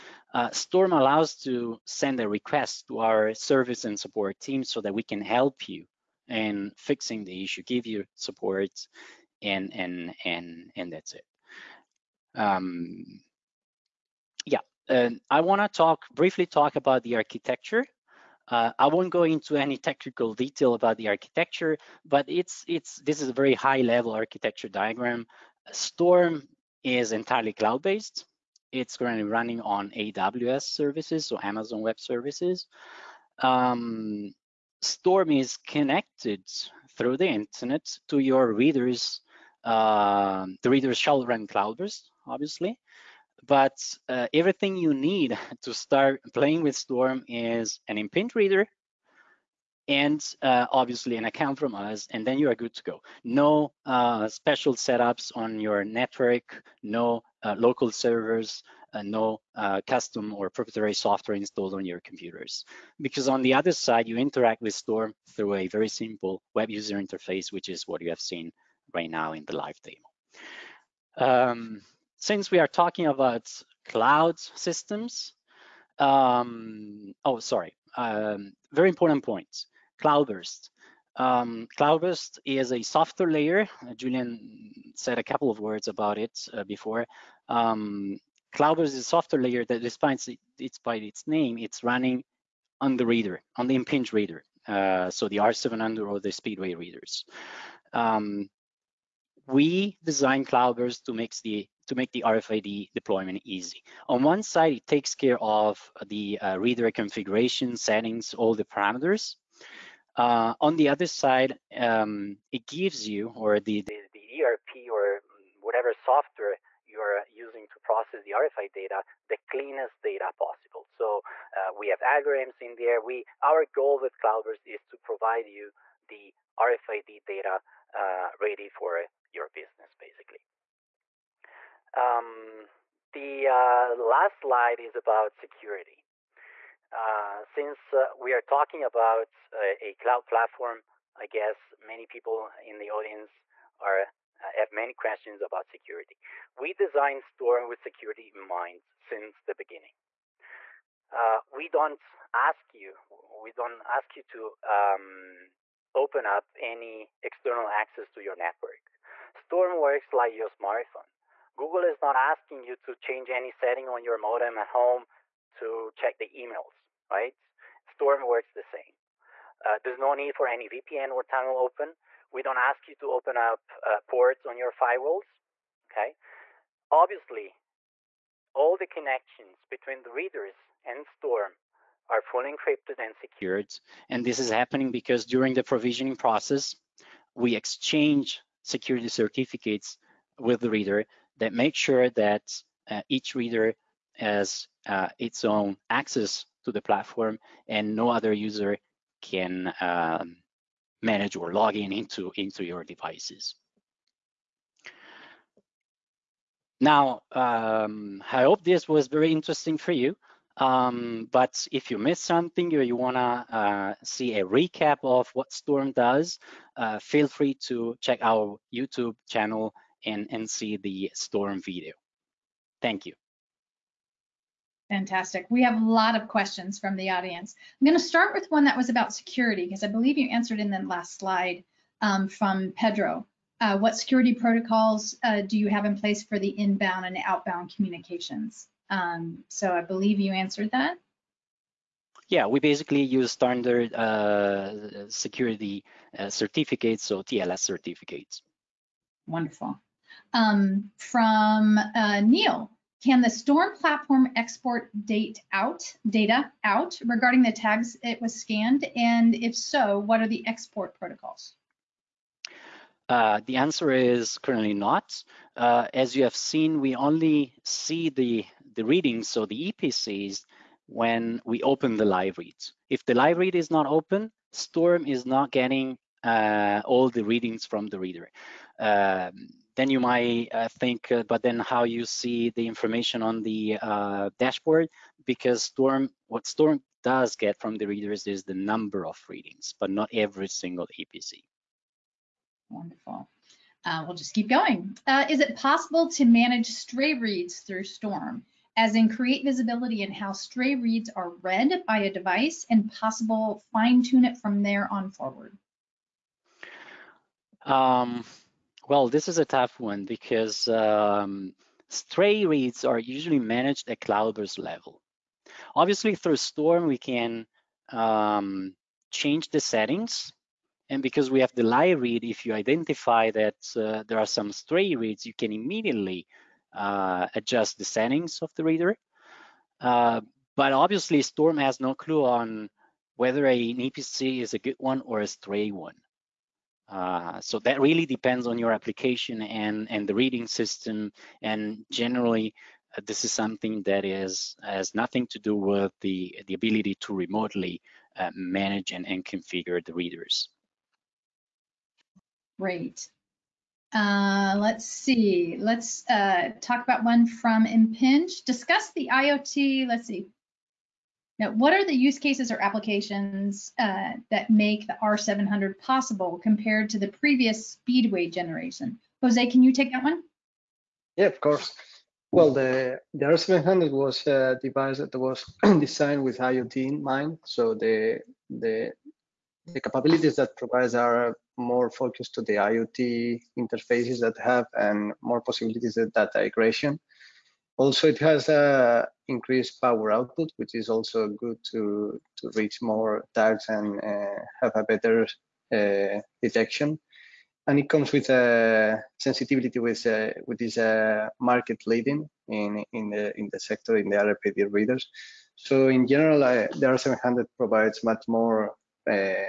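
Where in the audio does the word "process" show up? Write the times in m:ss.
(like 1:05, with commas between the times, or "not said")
1:57, 3:06.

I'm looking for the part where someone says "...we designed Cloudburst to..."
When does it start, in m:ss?
1:39.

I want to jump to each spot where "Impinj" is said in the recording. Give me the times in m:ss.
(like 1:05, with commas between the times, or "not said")
0:47, 1:33, 5:57.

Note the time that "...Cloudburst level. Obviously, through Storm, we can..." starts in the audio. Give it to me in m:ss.
5:14.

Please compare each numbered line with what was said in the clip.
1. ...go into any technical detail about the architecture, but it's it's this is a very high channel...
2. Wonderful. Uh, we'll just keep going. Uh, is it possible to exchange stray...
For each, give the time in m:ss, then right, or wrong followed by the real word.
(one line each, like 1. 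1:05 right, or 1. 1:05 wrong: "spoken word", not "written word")
1. 0:19 wrong: "level", not "channel"
2. 4:52 wrong: "manage", not "exchange".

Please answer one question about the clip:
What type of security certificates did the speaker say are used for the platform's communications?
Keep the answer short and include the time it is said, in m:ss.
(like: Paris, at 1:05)
TLS certificates, at 4:07.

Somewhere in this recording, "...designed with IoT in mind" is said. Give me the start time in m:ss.
6:15.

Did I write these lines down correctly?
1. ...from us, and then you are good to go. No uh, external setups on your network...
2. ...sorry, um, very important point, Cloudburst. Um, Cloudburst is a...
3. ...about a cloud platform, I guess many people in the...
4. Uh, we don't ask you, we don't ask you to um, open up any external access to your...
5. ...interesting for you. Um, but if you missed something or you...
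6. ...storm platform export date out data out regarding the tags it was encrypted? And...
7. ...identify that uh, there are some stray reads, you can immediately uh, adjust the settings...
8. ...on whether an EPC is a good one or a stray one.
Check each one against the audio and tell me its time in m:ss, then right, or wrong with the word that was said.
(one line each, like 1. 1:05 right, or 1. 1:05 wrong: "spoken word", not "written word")
1. 0:51 wrong: "special", not "external"
2. 1:17 right
3. 2:18 right
4. 2:31 right
5. 3:29 right
6. 4:13 wrong: "scanned", not "encrypted"
7. 5:22 right
8. 5:32 right.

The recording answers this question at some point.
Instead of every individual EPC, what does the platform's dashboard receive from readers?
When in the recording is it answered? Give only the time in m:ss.
4:48.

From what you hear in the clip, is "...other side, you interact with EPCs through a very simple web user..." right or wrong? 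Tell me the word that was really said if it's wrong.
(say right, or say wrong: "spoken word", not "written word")
wrong: "Storm", not "EPCs".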